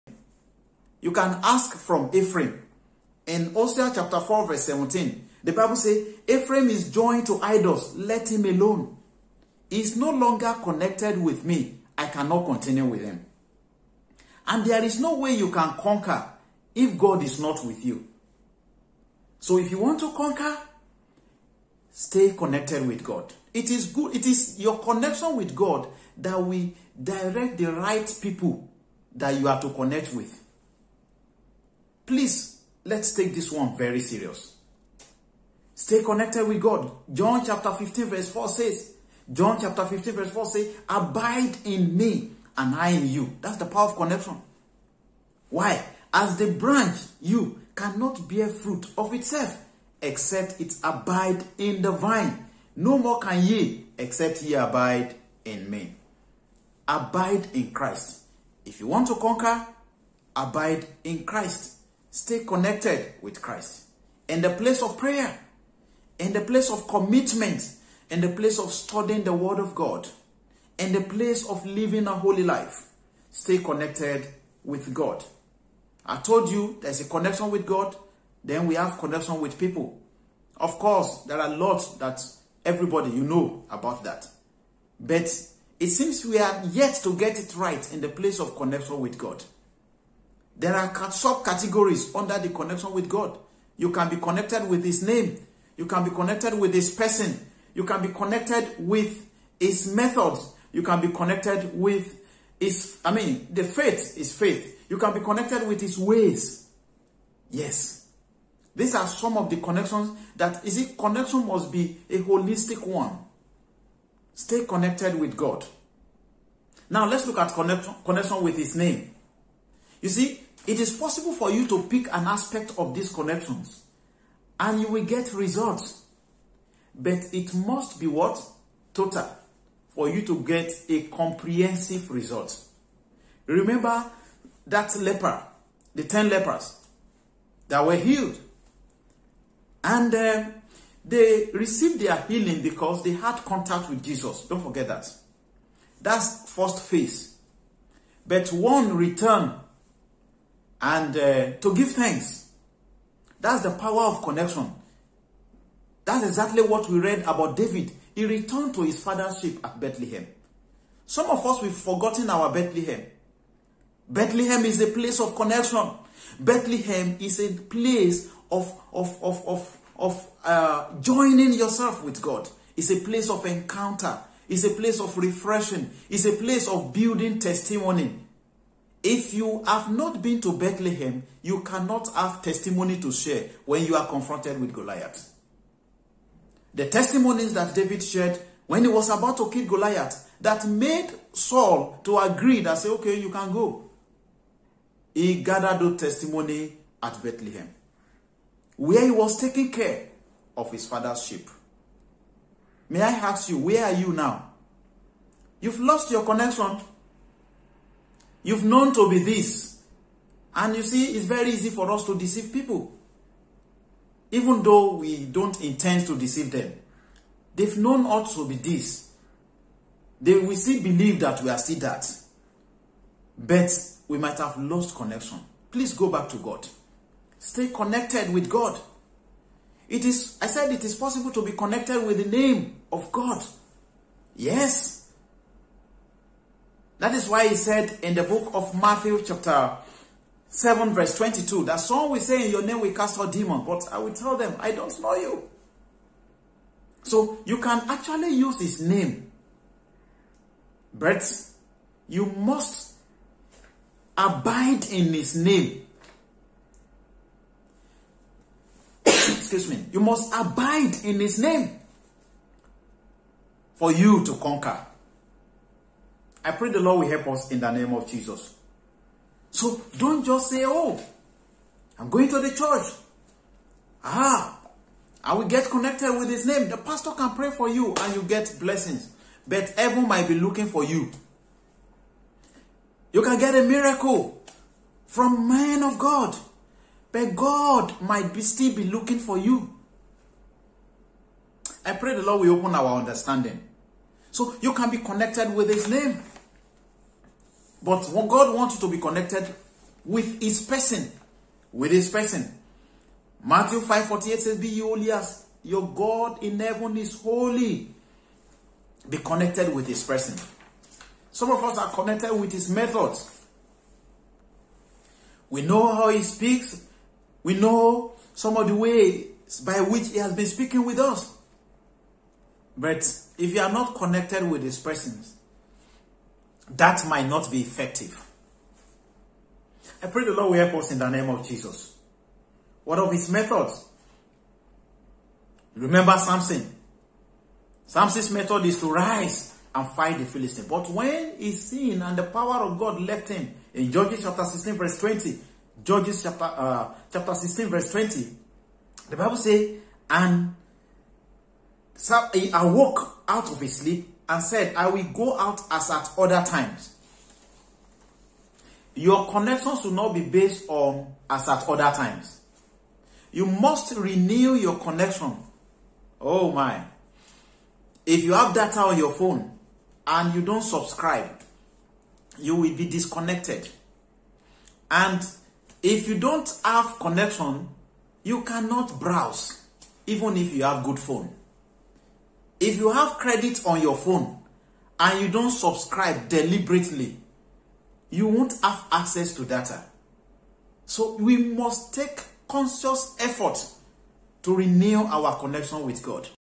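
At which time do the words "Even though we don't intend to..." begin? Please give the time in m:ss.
3:34.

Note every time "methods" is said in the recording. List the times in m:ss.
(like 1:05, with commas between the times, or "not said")
1:39, 5:12, 5:33, 5:38.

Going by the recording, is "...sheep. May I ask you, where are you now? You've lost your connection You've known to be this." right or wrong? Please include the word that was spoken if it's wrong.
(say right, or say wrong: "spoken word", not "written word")
right.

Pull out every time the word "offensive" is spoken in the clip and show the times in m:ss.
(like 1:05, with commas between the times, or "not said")
not said.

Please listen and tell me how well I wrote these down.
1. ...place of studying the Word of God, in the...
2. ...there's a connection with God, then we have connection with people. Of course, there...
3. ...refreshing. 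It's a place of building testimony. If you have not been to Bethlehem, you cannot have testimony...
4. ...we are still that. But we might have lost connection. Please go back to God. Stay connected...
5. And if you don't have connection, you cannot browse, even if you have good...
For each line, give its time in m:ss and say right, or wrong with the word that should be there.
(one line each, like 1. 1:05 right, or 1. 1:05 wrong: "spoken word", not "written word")
1. 1:08 right
2. 1:16 right
3. 2:55 right
4. 3:41 right
5. 6:14 right.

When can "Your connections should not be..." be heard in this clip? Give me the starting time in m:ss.
5:58.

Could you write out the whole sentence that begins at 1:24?
But it seems we are yet to get it right in the place of connection with God.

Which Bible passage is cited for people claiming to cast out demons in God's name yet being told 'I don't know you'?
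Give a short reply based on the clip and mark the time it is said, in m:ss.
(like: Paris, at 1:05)
Matthew 7:22, at 3:58.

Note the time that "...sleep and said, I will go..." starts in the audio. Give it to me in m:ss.
5:53.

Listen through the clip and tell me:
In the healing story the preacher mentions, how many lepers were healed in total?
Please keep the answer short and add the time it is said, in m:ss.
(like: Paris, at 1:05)
10, at 2:16.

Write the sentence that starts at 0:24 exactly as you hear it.
It is your connection with God that we direct the right people that you have to connect with.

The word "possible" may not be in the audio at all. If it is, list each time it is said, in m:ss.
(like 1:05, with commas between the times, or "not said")
2:00, 3:50.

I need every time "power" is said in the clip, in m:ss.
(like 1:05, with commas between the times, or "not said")
0:43, 2:33, 5:42.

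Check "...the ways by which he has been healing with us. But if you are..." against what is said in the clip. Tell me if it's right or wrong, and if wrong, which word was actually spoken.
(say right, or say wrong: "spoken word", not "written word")
wrong: "speaking", not "healing".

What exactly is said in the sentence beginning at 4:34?
Ah, I will get connected with his name.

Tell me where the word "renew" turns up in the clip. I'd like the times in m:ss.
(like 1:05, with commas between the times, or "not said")
6:03, 6:34.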